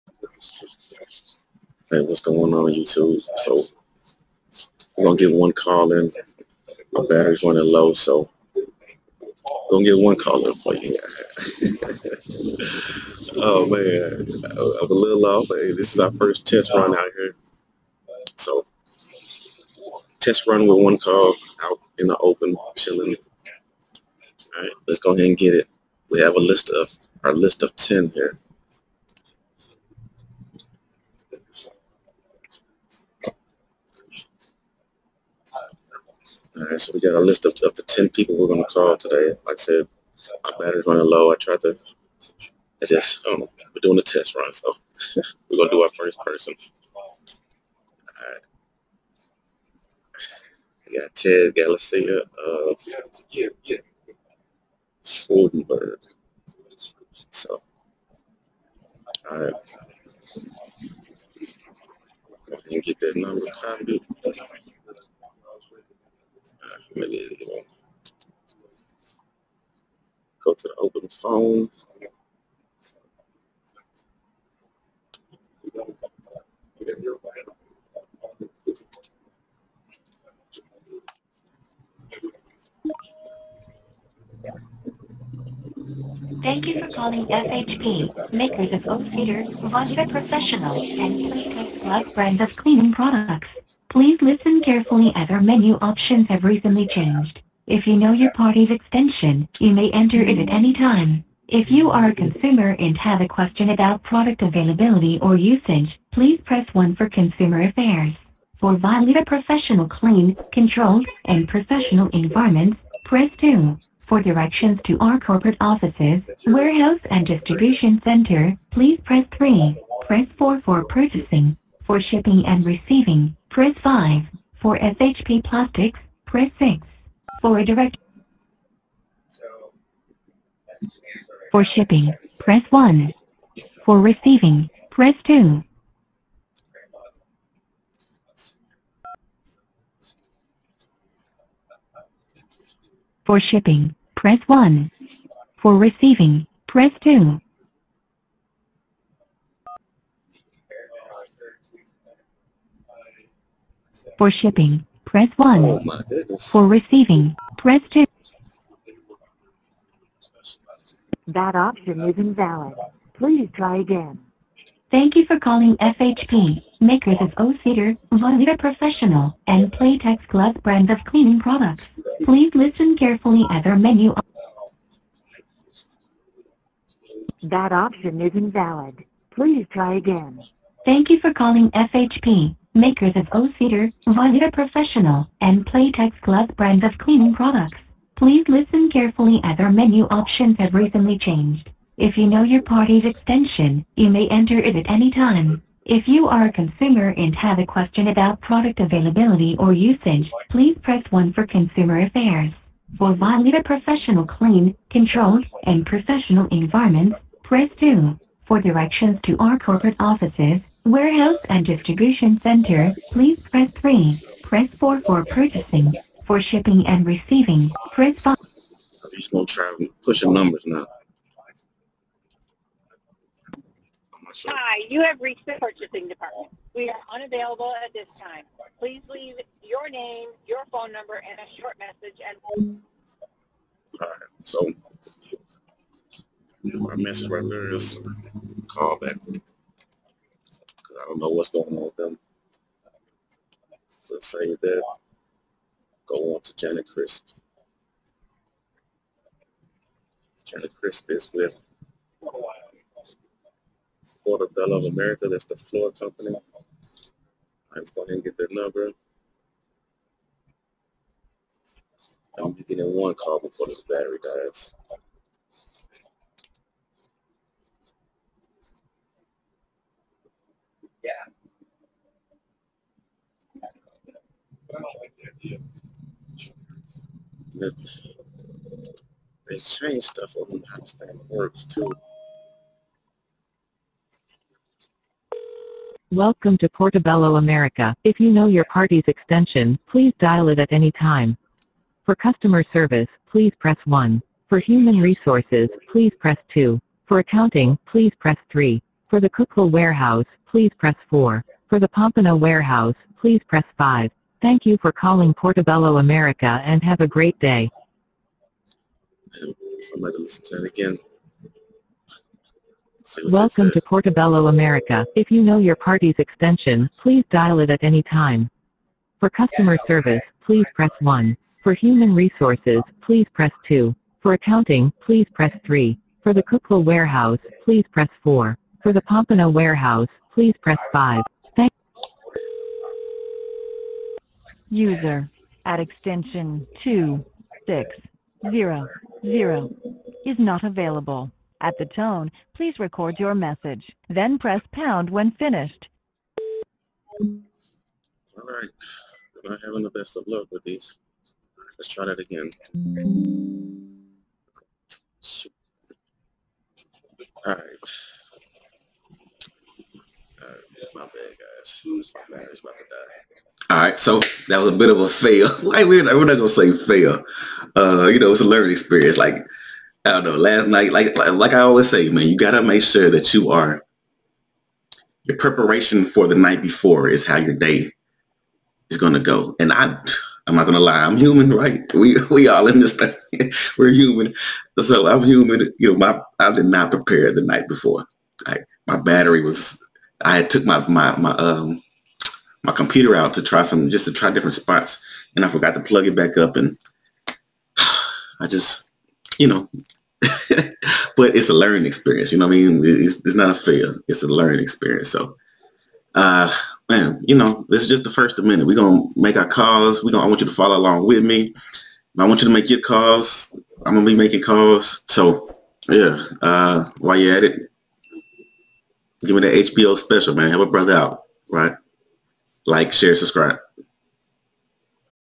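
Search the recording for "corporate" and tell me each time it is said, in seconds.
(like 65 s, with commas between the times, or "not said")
115 s, 209 s.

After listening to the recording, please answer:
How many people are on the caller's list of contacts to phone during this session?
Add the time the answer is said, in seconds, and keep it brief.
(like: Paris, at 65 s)
10, at 37 s.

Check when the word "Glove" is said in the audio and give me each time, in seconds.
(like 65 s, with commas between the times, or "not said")
170 s, 186 s.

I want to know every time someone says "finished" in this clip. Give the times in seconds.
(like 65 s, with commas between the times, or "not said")
345 s.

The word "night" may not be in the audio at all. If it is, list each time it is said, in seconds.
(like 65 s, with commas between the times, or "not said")
370 s, 376 s, 387 s.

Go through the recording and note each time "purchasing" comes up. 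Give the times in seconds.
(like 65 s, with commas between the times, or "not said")
120 s, 215 s, 225 s.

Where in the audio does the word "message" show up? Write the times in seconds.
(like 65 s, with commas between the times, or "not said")
231 s, 236 s, 343 s.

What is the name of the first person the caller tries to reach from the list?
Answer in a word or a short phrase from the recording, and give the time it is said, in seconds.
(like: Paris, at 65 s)
Ted Galicia, at 51 s.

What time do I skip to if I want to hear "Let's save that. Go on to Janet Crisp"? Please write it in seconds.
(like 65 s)
244 s.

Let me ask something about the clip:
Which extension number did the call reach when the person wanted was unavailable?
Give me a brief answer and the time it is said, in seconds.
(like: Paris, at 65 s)
2600, at 336 s.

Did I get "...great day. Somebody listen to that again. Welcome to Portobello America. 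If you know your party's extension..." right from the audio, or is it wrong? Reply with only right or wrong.
right.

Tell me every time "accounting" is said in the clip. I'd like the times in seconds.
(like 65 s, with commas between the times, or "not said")
297 s, 324 s.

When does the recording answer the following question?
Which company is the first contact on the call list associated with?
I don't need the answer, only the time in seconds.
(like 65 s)
55 s.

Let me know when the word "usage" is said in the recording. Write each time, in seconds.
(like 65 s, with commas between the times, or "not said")
105 s, 199 s.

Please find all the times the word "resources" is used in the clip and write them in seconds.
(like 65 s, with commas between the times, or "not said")
294 s, 322 s.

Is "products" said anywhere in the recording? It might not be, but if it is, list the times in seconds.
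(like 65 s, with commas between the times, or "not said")
92 s, 104 s, 171 s, 187 s, 198 s.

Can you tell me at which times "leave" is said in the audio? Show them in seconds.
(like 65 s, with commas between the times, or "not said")
229 s.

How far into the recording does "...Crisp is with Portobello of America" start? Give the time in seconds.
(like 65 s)
250 s.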